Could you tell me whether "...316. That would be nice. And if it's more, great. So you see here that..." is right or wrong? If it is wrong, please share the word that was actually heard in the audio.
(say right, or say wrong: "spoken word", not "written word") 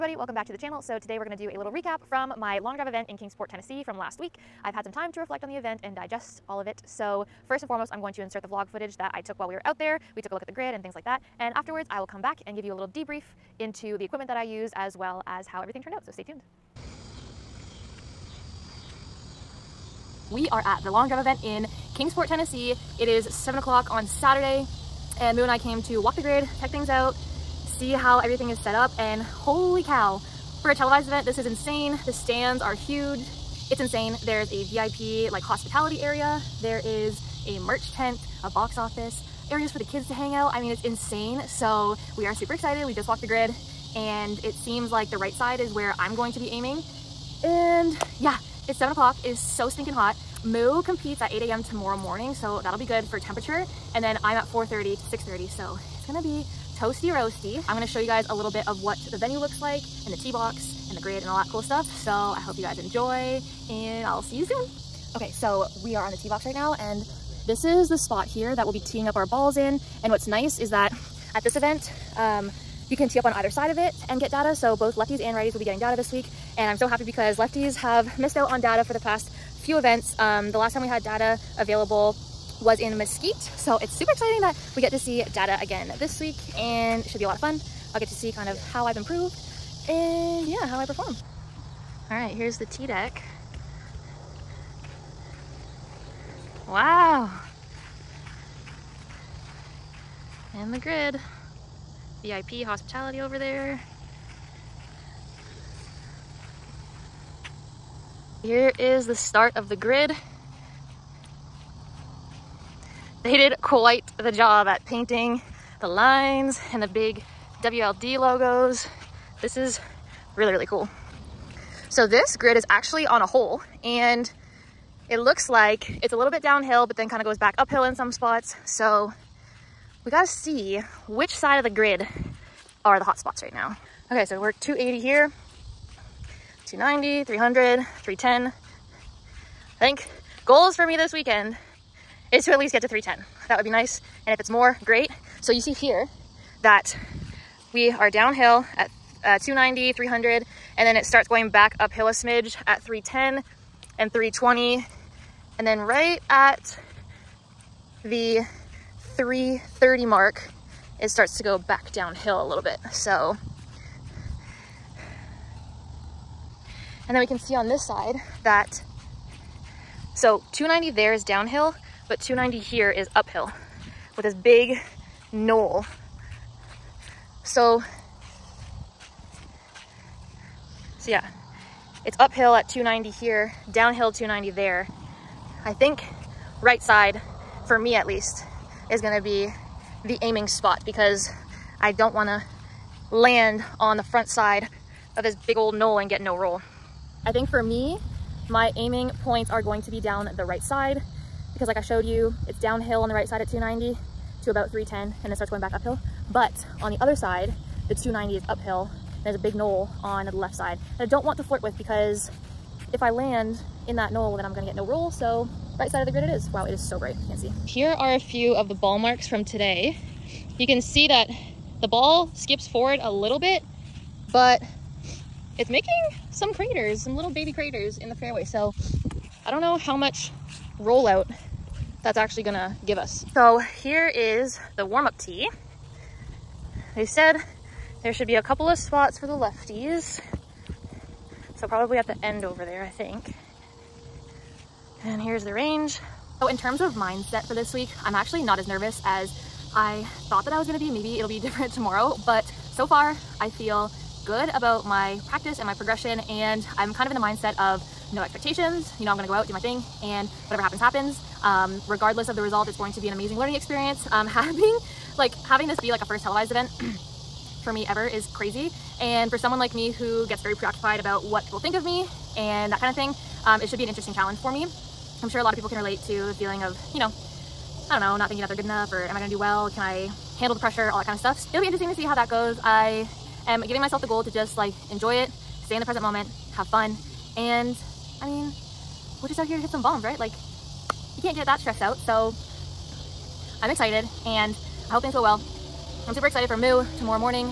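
wrong: "310", not "316".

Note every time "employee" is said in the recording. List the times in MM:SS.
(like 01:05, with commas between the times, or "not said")
not said.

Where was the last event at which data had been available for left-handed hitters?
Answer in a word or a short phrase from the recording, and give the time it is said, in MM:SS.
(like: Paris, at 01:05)
Mesquite, at 01:22.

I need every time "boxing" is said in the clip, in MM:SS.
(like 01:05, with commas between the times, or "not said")
not said.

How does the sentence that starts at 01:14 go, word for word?
So both lefties and righties will be getting data this week.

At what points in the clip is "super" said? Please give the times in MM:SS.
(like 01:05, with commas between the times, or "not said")
00:42, 01:23, 04:56.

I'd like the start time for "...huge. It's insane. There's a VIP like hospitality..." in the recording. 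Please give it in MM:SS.
00:32.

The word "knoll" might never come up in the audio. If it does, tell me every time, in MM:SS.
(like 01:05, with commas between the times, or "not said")
02:55, 03:15, 03:29, 03:34.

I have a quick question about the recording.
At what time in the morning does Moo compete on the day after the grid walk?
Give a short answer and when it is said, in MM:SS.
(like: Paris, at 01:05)
8 a.m., at 00:51.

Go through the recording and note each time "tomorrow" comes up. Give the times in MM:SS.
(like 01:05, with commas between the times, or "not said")
00:51, 04:11, 04:56.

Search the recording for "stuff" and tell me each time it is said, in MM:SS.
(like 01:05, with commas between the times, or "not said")
01:01, 04:41.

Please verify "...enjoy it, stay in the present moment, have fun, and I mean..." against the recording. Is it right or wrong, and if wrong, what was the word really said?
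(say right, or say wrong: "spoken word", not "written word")
right.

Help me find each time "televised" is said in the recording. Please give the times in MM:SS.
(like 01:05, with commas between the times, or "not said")
00:30, 04:26.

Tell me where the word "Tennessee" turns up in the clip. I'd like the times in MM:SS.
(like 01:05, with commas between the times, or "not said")
00:03, 00:22.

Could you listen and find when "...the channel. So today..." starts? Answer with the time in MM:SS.
00:00.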